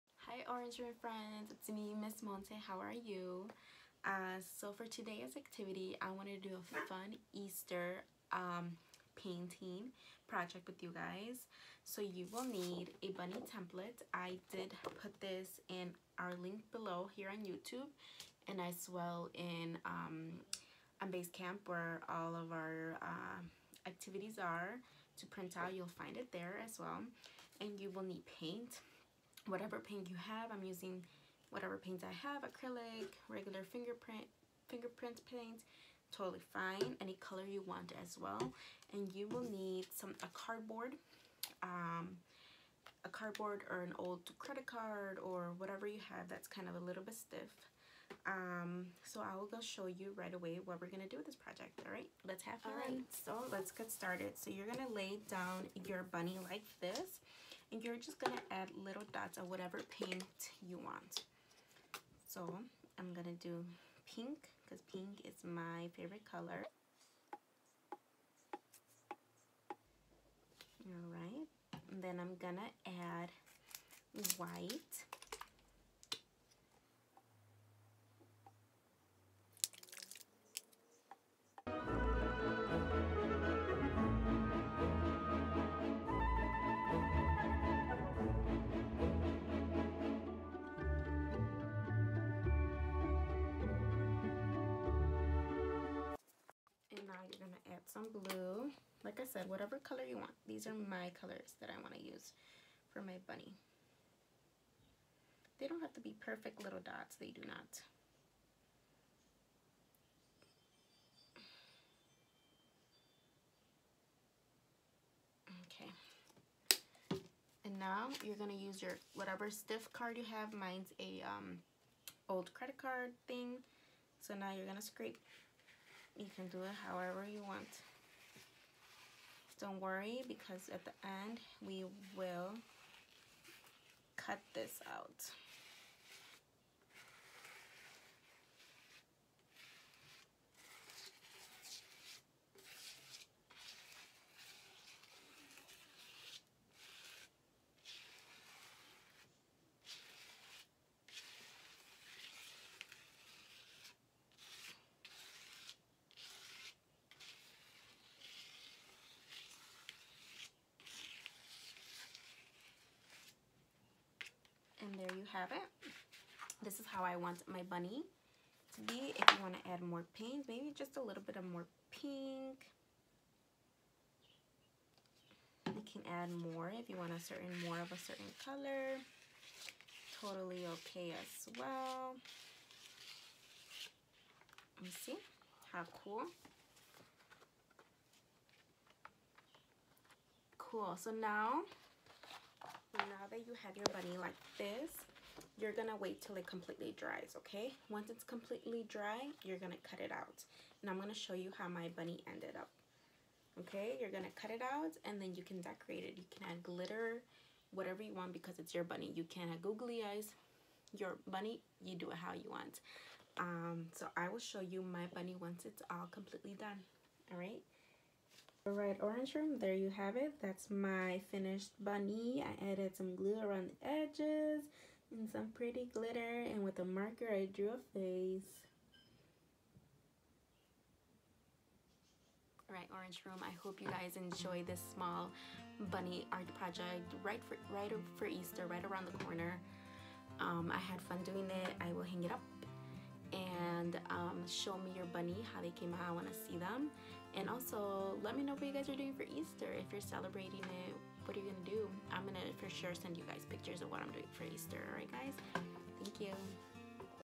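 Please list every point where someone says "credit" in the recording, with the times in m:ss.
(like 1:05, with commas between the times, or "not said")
0:44, 2:02.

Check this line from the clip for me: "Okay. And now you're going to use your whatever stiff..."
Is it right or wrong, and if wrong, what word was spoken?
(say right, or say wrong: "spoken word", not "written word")
right.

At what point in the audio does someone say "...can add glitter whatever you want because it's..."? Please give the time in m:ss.
3:26.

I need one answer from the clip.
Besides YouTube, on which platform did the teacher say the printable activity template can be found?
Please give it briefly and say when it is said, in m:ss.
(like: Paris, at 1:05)
Basecamp, at 0:21.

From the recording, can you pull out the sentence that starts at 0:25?
You'll find it there as well.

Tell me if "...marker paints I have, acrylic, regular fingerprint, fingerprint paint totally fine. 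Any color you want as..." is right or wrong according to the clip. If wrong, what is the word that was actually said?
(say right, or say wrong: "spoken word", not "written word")
wrong: "whatever", not "marker".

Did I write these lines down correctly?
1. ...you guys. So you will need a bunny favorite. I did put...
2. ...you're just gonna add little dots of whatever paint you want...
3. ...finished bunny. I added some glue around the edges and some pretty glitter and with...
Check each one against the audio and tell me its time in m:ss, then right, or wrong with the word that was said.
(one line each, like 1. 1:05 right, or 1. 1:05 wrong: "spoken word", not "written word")
1. 0:10 wrong: "template", not "favorite"
2. 0:57 right
3. 3:41 right.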